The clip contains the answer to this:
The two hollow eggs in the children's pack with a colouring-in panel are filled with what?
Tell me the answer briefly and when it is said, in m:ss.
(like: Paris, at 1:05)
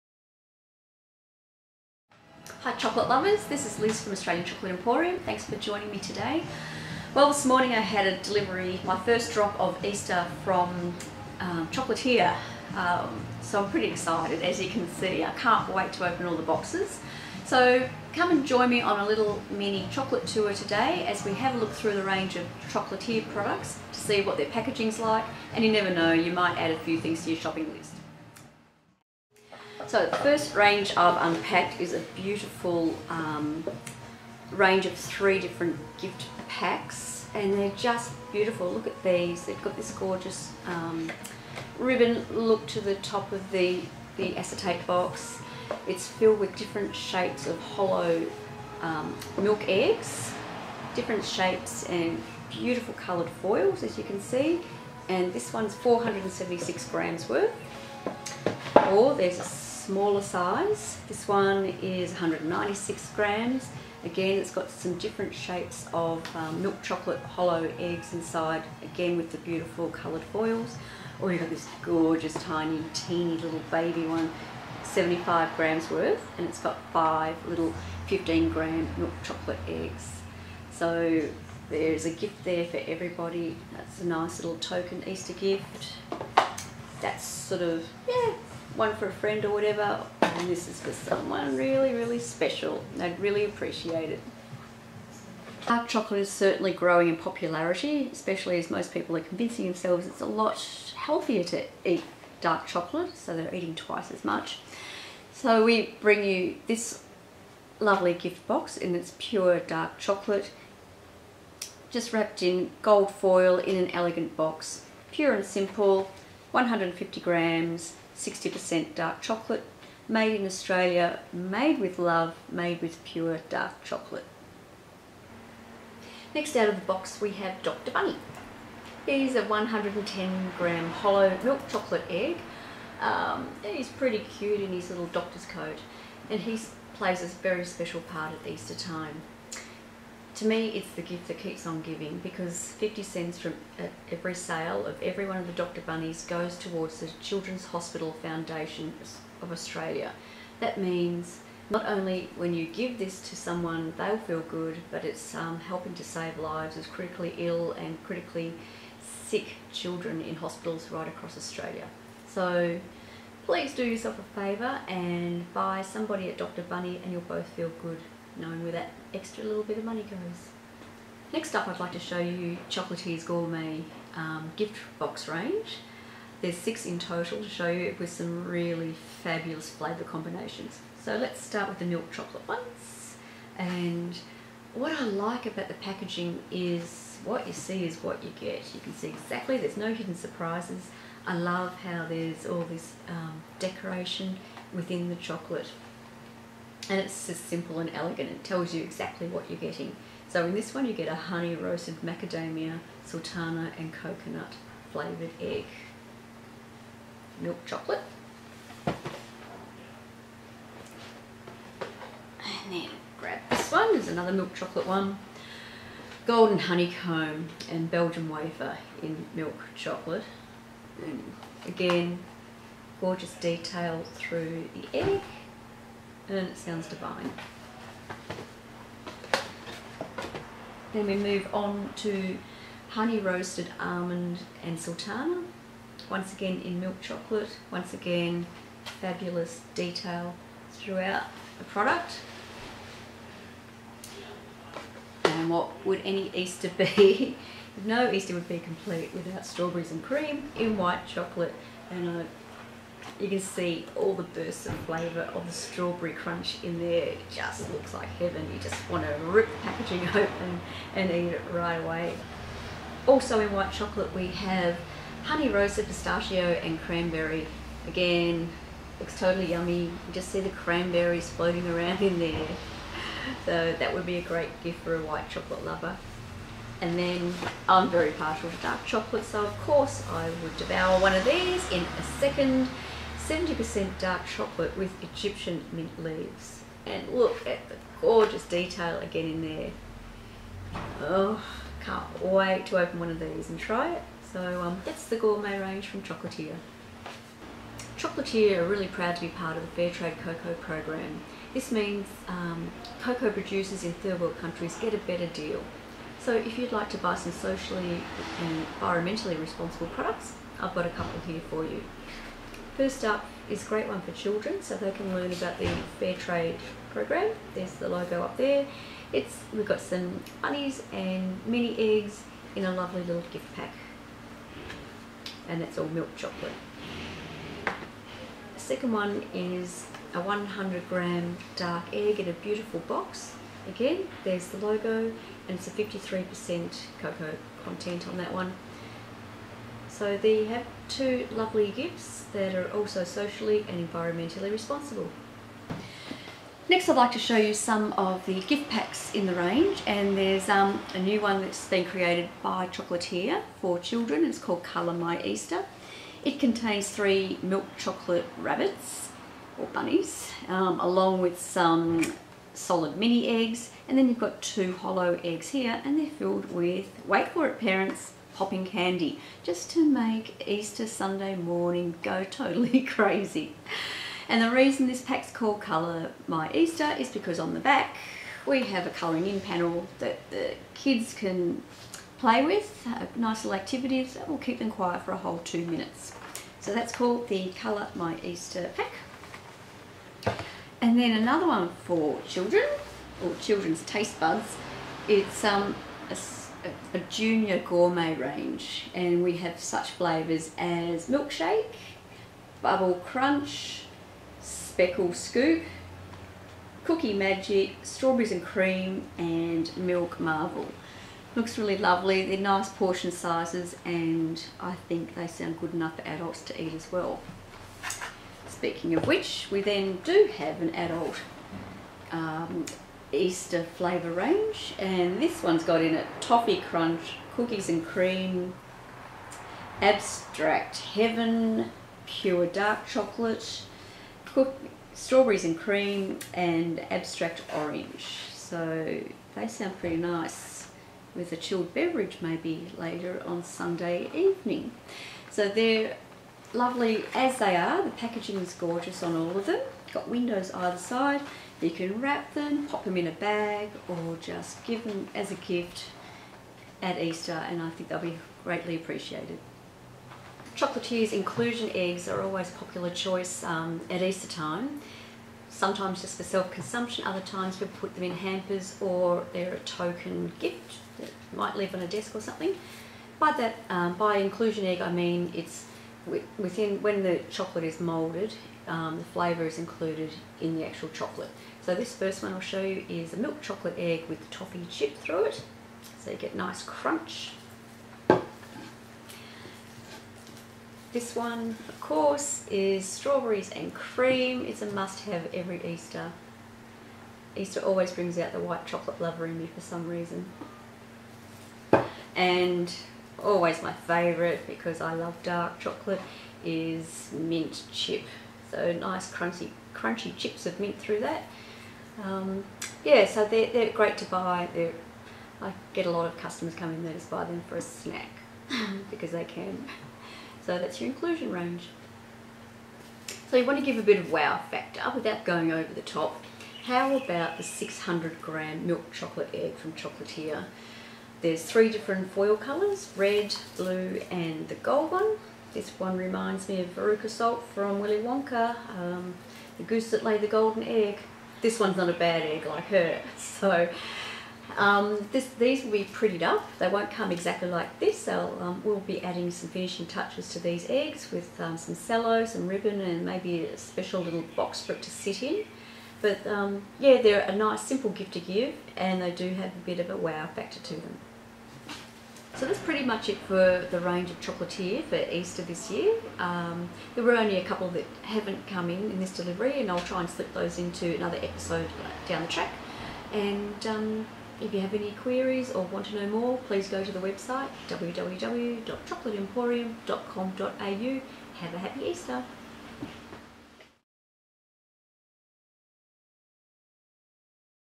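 popping candy, at 6:08.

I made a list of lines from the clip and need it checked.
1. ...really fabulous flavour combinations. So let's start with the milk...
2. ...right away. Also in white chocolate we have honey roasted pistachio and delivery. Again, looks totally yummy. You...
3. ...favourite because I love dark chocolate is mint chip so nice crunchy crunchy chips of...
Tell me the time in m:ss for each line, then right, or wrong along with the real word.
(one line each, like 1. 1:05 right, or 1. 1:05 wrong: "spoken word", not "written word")
1. 2:58 right
2. 4:21 wrong: "cranberry", not "delivery"
3. 8:23 right.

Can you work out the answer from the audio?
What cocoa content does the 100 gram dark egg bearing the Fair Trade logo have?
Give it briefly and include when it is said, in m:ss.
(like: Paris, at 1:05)
53%, at 5:35.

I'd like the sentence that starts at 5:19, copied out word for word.
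It's We've got some bunnies and mini eggs in a lovely little gift pack.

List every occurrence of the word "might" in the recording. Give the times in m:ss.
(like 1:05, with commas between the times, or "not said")
0:26, 7:51.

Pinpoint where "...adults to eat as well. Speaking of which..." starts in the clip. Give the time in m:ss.
6:56.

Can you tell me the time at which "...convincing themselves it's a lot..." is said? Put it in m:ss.
1:39.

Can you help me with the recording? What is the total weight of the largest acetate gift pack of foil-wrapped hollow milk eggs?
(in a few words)
476 grams.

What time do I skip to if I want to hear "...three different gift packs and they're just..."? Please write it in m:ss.
0:34.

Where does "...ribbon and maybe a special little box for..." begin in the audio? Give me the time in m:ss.
9:12.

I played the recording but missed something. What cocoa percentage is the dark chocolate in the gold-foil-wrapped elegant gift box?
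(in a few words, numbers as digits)
60%.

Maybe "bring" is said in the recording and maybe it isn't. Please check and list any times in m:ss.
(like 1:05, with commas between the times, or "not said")
1:46, 8:17.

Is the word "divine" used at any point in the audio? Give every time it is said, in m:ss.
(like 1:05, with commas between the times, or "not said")
3:46.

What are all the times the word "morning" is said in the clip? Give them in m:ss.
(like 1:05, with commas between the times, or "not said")
0:07, 6:11.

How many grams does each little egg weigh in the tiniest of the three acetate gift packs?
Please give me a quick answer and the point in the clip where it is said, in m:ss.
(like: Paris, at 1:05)
15 grams, at 1:18.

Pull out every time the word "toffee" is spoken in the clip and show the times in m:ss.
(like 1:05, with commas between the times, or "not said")
7:06, 8:04.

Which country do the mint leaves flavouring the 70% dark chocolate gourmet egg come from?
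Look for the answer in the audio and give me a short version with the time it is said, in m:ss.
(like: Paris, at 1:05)
Egyptian, at 4:45.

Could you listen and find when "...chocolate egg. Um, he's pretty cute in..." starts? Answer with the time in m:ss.
2:11.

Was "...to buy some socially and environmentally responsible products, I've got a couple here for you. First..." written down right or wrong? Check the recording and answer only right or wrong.
right.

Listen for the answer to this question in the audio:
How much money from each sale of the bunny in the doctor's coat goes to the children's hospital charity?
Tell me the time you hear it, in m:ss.
2:22.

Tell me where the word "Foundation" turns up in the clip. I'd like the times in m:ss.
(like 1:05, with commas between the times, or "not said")
2:28.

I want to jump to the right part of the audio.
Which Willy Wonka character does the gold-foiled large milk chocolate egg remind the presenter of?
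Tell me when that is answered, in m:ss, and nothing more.
8:56.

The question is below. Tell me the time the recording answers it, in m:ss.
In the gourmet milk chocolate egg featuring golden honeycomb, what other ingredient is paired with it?
3:37.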